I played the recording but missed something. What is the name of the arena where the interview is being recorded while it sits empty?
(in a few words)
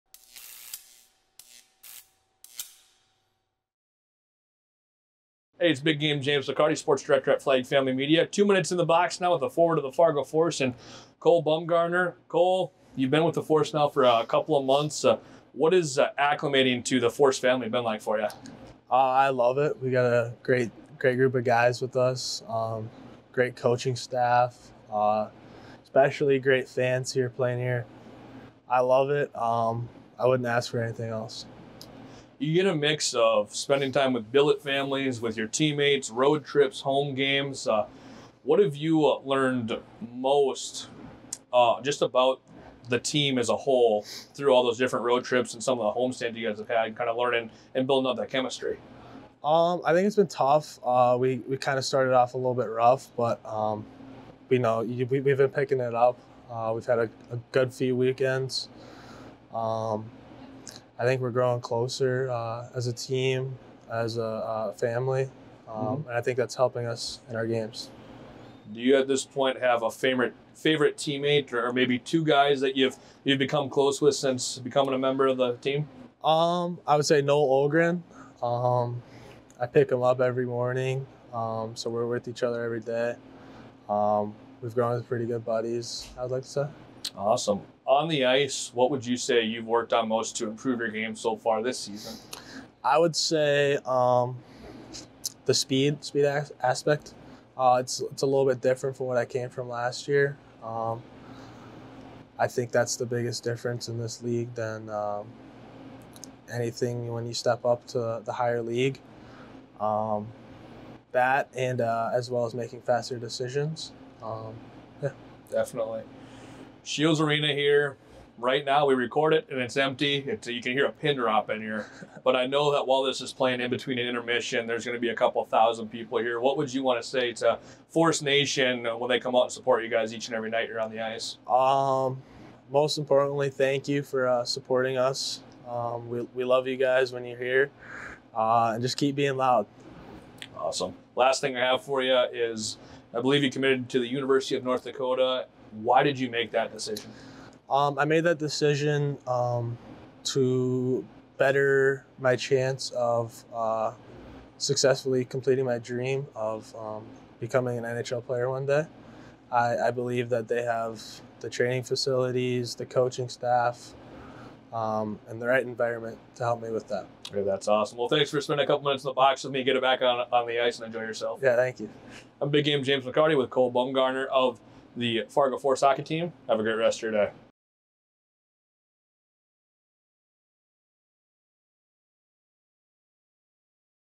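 Scheels Arena.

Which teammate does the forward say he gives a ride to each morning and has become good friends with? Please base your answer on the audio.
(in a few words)
Noel Olgren.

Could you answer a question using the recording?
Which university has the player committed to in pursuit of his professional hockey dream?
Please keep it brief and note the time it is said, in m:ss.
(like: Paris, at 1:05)
University of North Dakota, at 2:24.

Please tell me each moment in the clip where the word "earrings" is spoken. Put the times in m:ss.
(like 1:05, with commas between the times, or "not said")
not said.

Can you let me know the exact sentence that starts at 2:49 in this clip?
Get it back on, on the ice and enjoy yourself.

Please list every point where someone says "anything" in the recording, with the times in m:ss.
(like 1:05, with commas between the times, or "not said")
0:30, 1:46.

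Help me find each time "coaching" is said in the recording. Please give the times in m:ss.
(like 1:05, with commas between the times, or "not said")
0:23, 2:42.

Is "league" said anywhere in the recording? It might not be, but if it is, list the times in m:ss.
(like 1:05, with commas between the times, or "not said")
1:44, 1:48.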